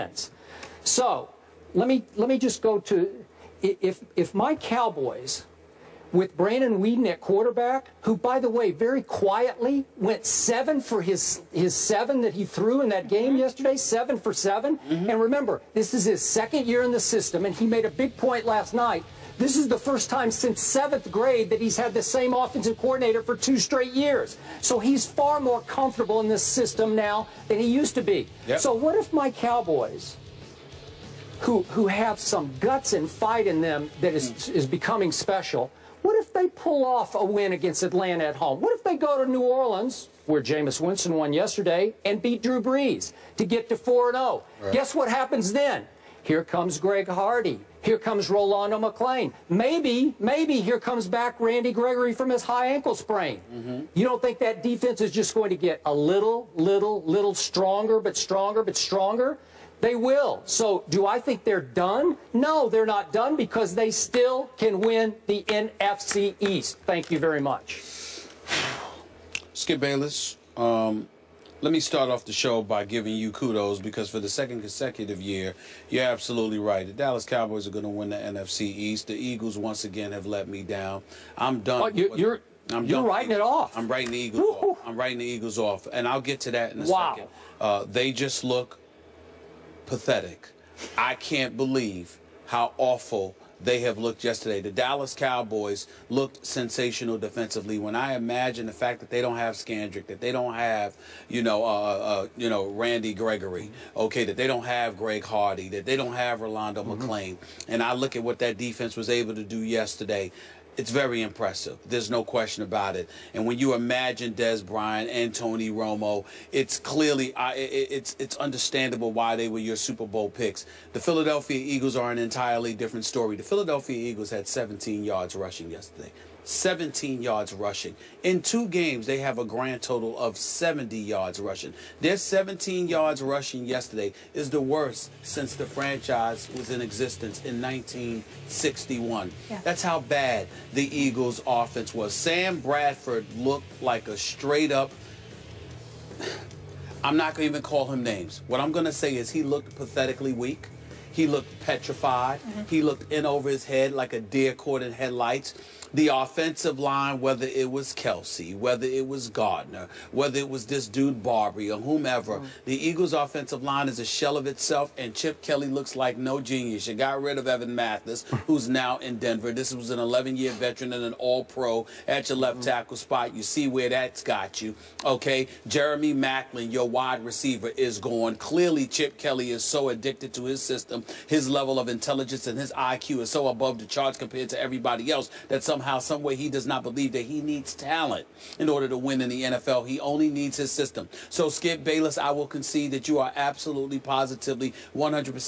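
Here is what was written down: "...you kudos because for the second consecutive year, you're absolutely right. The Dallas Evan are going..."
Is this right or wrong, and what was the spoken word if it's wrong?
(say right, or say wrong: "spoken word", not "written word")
wrong: "Cowboys", not "Evan".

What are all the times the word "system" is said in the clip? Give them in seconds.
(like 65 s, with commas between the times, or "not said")
17 s, 26 s, 180 s, 190 s.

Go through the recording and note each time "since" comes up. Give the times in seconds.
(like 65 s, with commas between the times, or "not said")
20 s, 135 s.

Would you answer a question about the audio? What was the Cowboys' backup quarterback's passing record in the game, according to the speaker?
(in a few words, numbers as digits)
7 for 7.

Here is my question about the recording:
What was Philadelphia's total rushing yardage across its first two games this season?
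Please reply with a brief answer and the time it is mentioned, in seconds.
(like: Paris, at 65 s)
70 yards, at 130 s.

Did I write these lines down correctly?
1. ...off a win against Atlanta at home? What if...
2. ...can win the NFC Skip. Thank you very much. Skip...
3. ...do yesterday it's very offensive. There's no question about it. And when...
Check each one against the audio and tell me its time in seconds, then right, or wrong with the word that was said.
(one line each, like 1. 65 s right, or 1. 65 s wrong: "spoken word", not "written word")
1. 36 s right
2. 64 s wrong: "East", not "Skip"
3. 109 s wrong: "impressive", not "offensive".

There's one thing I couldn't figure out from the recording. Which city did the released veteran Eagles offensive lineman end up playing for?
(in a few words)
Denver.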